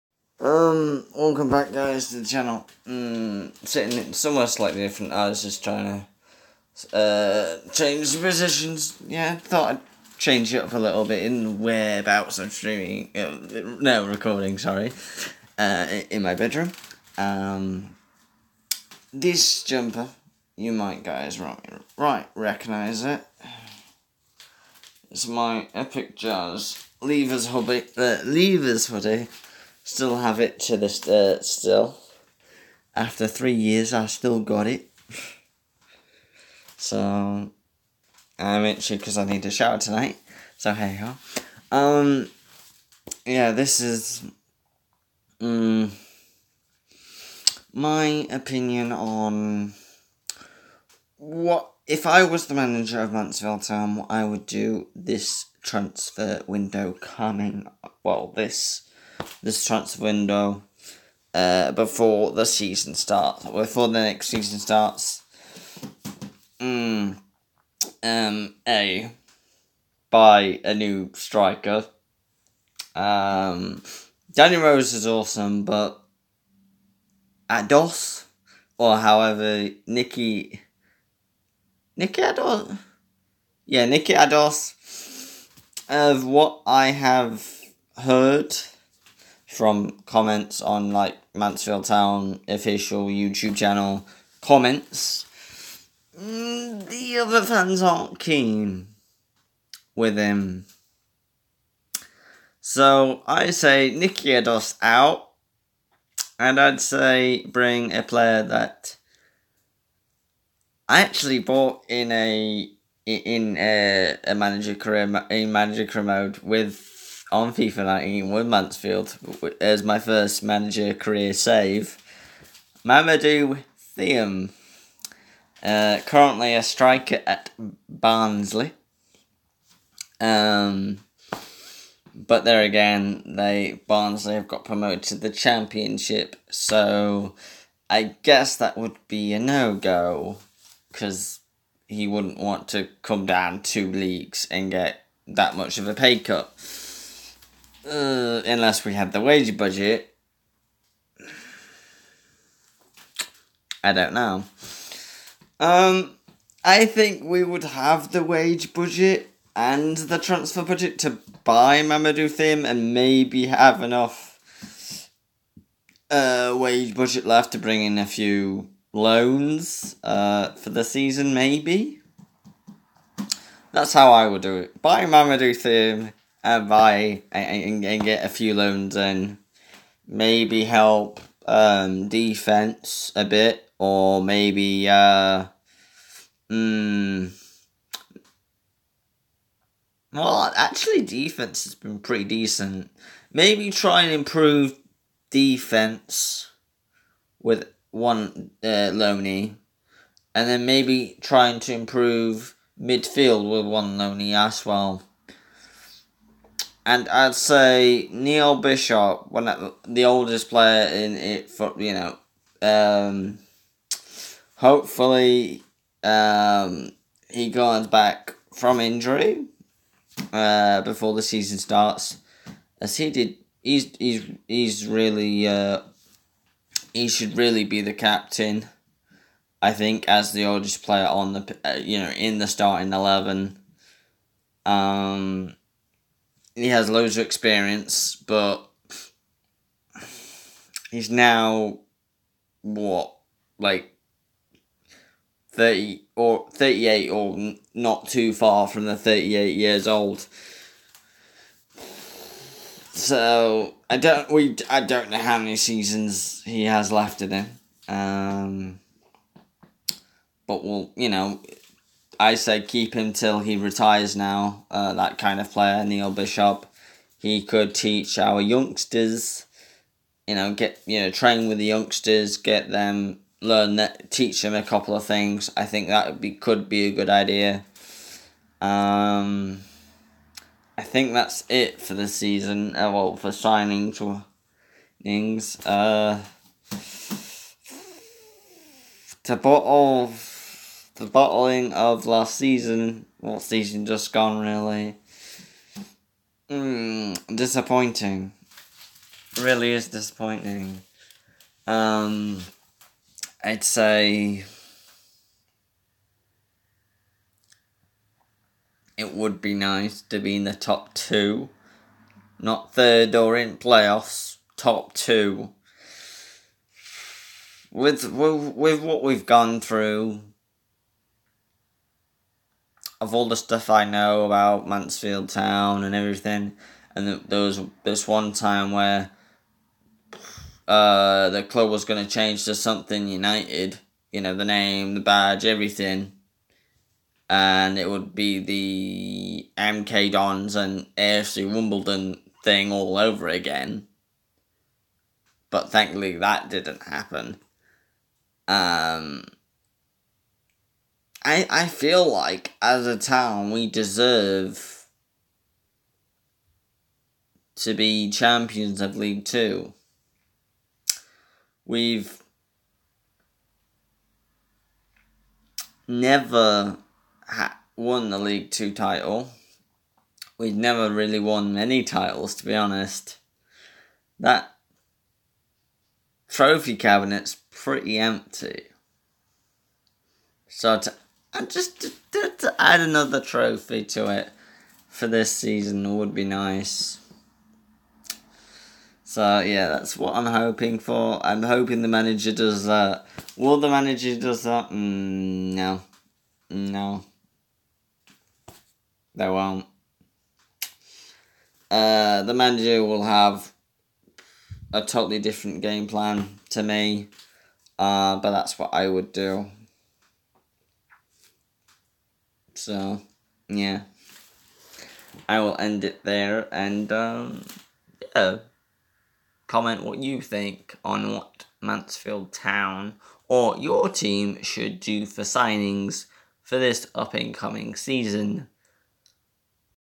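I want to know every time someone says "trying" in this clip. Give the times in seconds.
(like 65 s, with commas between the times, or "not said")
5 s, 201 s.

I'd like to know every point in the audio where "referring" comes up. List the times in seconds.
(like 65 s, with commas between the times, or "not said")
not said.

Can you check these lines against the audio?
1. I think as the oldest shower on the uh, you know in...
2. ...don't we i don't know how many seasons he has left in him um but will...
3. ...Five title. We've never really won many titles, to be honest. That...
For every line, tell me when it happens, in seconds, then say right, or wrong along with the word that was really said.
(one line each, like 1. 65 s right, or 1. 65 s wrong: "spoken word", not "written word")
1. 229 s wrong: "player", not "shower"
2. 253 s right
3. 368 s wrong: "Two", not "Five".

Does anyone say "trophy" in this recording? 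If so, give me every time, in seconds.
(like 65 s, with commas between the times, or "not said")
376 s, 383 s.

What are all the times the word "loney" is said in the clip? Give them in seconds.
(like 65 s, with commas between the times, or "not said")
198 s, 203 s.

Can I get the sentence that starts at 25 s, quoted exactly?
It's my Epic Jazz Levers hobby.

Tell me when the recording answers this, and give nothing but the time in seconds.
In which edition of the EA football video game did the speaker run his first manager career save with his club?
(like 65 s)
117 s.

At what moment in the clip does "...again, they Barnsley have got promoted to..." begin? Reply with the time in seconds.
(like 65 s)
132 s.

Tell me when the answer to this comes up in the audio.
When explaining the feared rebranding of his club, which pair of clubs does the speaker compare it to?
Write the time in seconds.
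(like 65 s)
339 s.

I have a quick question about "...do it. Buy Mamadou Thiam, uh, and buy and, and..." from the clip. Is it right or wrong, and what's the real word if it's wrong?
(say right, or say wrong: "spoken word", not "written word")
right.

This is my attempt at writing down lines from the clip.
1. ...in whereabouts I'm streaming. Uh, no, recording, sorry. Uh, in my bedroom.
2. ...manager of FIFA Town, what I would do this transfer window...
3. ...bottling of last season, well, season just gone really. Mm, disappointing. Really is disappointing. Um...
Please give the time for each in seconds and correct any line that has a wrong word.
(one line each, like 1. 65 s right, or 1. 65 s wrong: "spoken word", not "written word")
1. 11 s right
2. 52 s wrong: "Mansfield", not "FIFA"
3. 291 s right.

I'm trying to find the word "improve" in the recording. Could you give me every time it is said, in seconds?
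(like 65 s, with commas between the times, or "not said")
194 s, 201 s.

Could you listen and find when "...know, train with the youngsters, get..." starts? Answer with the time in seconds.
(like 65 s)
270 s.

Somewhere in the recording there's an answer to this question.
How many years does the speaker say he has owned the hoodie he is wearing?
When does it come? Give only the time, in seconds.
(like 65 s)
33 s.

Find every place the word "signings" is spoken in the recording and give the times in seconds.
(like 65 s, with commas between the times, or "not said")
283 s, 425 s.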